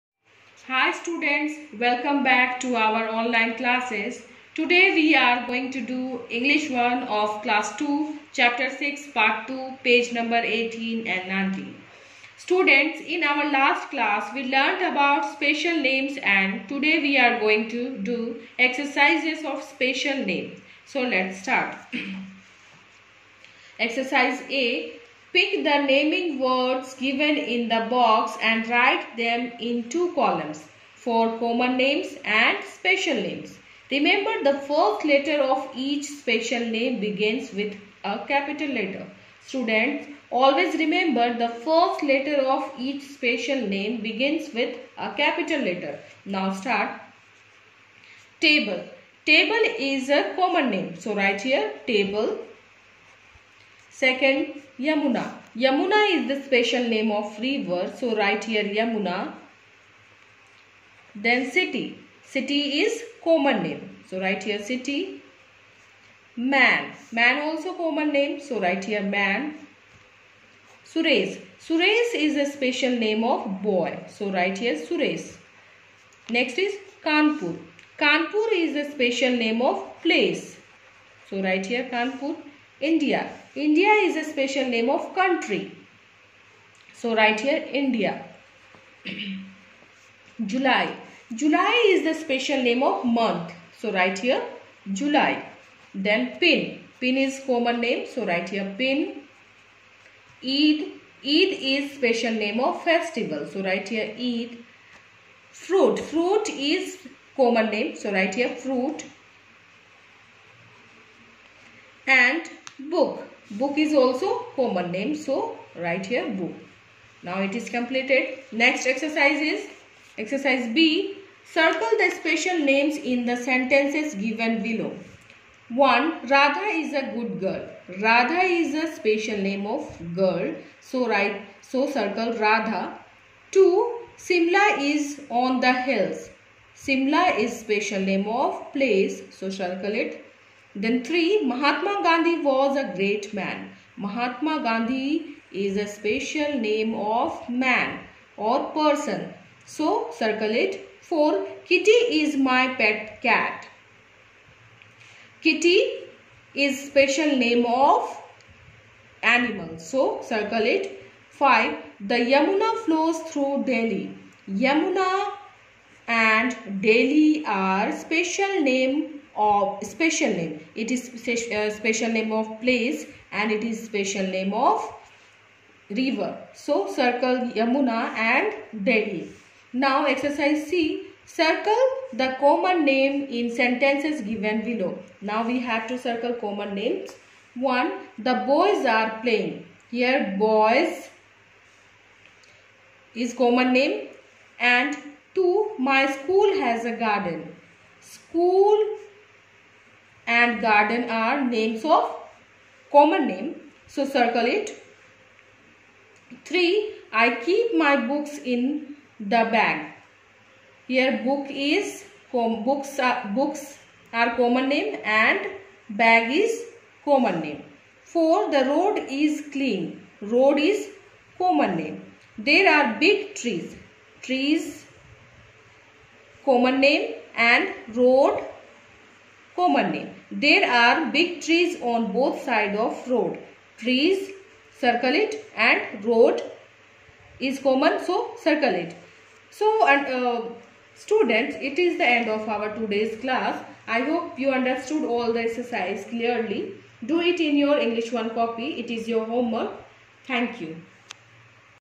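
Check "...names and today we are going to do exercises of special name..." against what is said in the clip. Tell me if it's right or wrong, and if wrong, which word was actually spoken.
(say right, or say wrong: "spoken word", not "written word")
right.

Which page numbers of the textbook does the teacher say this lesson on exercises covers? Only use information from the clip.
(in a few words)
18 and 19.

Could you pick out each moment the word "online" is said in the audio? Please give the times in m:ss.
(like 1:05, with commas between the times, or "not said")
0:03.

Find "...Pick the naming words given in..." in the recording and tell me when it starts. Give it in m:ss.
0:25.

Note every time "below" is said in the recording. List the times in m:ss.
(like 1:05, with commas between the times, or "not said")
2:04, 3:04.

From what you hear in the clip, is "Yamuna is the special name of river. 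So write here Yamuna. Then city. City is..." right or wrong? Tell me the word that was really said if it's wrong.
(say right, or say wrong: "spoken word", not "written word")
right.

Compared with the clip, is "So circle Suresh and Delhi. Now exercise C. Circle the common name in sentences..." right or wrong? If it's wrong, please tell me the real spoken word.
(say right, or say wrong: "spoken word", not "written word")
wrong: "Yamuna", not "Suresh".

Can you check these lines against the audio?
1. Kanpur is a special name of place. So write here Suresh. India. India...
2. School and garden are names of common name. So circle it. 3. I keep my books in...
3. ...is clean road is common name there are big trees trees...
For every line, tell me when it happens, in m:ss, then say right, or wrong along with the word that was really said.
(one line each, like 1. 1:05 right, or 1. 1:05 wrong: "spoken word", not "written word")
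1. 1:17 wrong: "Kanpur", not "Suresh"
2. 3:18 right
3. 3:39 right.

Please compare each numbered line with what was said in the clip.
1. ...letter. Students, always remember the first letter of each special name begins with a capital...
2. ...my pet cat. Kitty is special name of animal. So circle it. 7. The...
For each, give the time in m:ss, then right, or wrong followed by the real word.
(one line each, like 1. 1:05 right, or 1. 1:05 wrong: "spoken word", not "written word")
1. 0:38 right
2. 2:32 wrong: "5", not "7".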